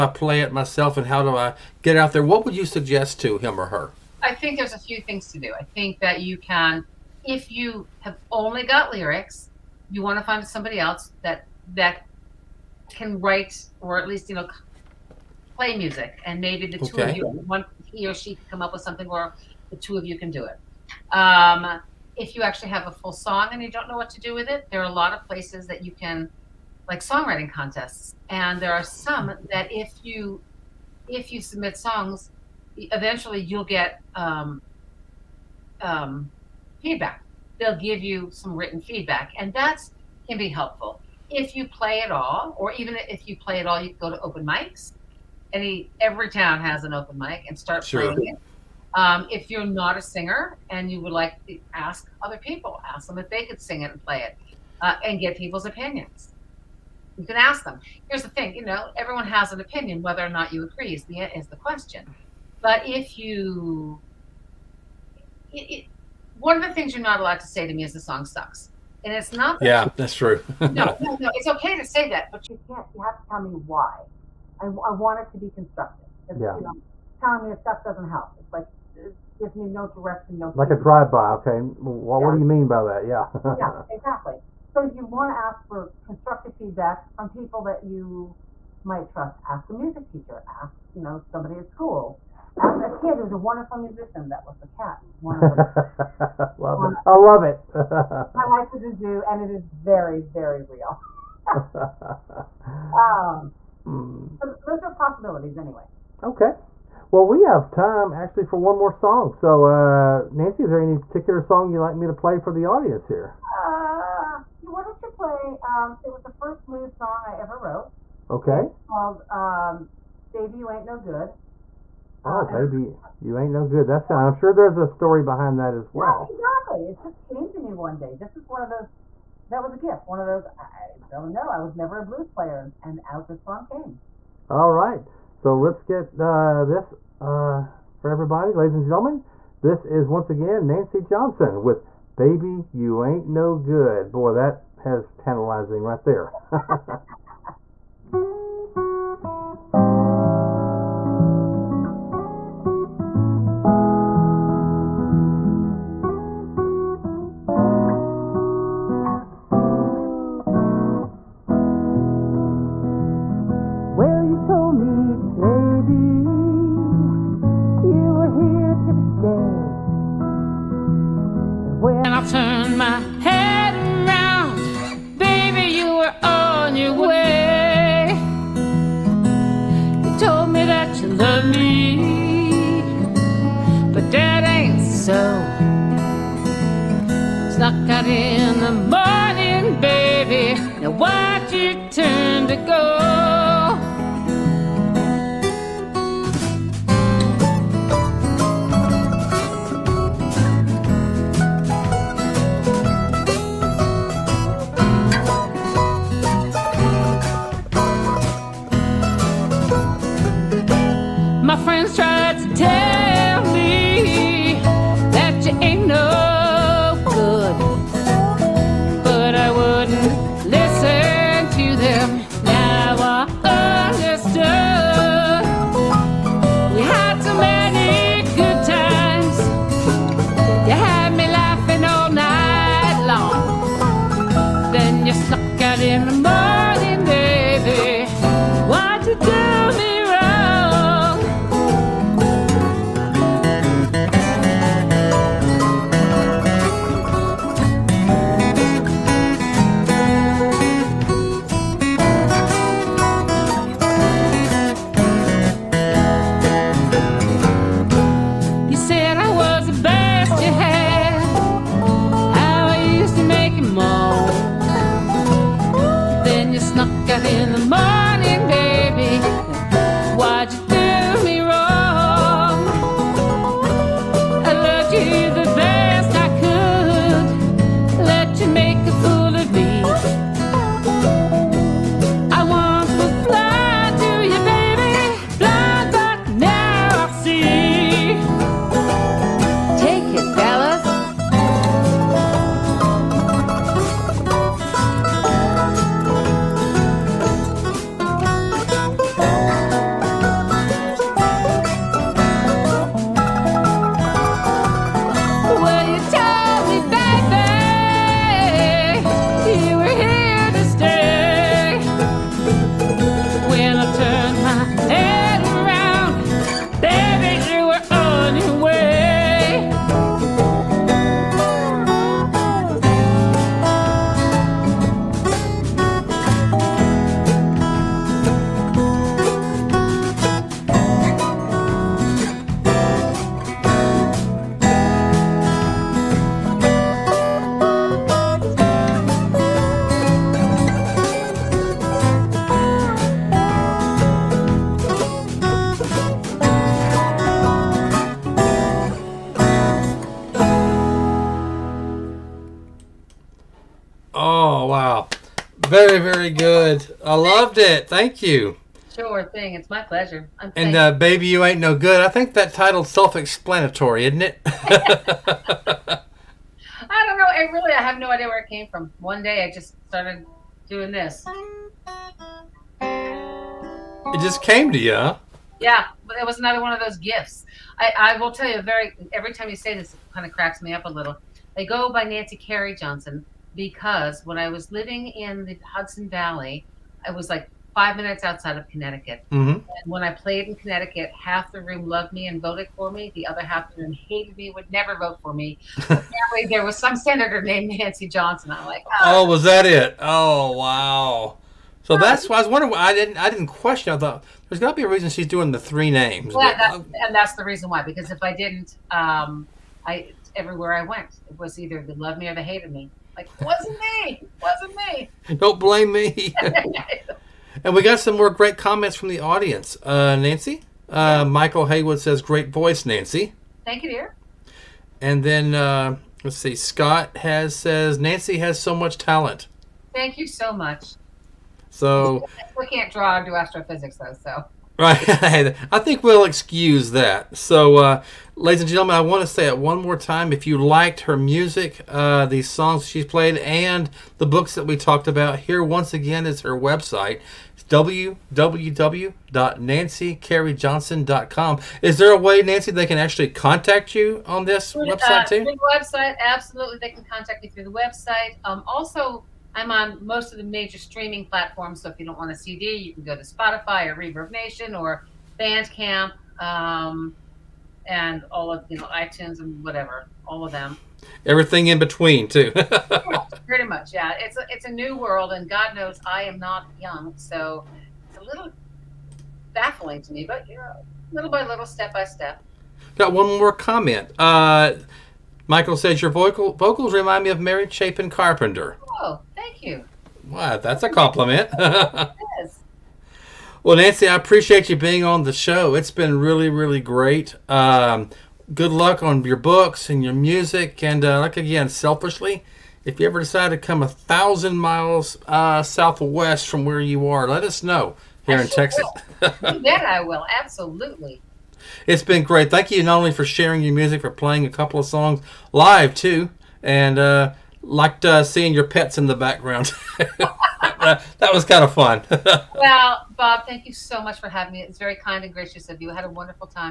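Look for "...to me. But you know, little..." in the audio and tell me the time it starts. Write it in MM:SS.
08:00.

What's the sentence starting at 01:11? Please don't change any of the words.
It's okay to say that, but you can't, you have to tell me why.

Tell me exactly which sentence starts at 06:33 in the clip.
The other half of the room hated me, would never vote for me.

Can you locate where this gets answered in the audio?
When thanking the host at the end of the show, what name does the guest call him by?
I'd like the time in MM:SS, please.
08:43.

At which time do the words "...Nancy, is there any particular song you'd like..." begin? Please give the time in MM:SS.
01:50.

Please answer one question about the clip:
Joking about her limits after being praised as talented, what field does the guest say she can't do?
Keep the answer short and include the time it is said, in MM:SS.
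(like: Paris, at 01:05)
Astrophysics, at 07:13.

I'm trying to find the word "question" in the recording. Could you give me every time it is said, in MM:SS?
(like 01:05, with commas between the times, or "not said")
01:01, 06:43.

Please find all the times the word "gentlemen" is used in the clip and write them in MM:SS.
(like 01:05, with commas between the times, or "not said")
02:18, 07:18.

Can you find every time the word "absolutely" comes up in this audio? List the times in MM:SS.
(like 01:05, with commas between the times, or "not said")
07:36, 08:30.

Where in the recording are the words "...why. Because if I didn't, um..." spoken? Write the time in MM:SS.
06:47.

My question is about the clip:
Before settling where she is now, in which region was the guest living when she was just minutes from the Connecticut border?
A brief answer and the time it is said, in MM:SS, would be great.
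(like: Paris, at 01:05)
Hudson Valley, at 06:25.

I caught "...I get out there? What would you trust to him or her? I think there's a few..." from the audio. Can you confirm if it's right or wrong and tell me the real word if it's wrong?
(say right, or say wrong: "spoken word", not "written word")
wrong: "suggest", not "trust".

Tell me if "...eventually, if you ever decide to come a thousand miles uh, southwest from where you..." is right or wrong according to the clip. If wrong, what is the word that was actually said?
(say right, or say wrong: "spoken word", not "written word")
wrong: "selfishly", not "eventually".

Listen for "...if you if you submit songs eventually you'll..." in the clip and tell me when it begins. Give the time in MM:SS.
00:29.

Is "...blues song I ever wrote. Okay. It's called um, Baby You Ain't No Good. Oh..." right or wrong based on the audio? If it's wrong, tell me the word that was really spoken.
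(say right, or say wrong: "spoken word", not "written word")
right.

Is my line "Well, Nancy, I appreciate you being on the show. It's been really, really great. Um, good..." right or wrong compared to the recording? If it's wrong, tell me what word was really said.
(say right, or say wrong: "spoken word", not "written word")
right.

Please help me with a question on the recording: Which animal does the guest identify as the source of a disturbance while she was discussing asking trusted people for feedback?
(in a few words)
Cat.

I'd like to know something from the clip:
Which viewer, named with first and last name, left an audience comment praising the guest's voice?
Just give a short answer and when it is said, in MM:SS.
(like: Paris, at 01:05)
Michael Haywood, at 07:01.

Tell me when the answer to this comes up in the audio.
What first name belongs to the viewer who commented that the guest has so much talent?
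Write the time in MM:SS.
07:06.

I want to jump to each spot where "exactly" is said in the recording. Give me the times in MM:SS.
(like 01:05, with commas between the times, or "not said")
01:23, 02:06.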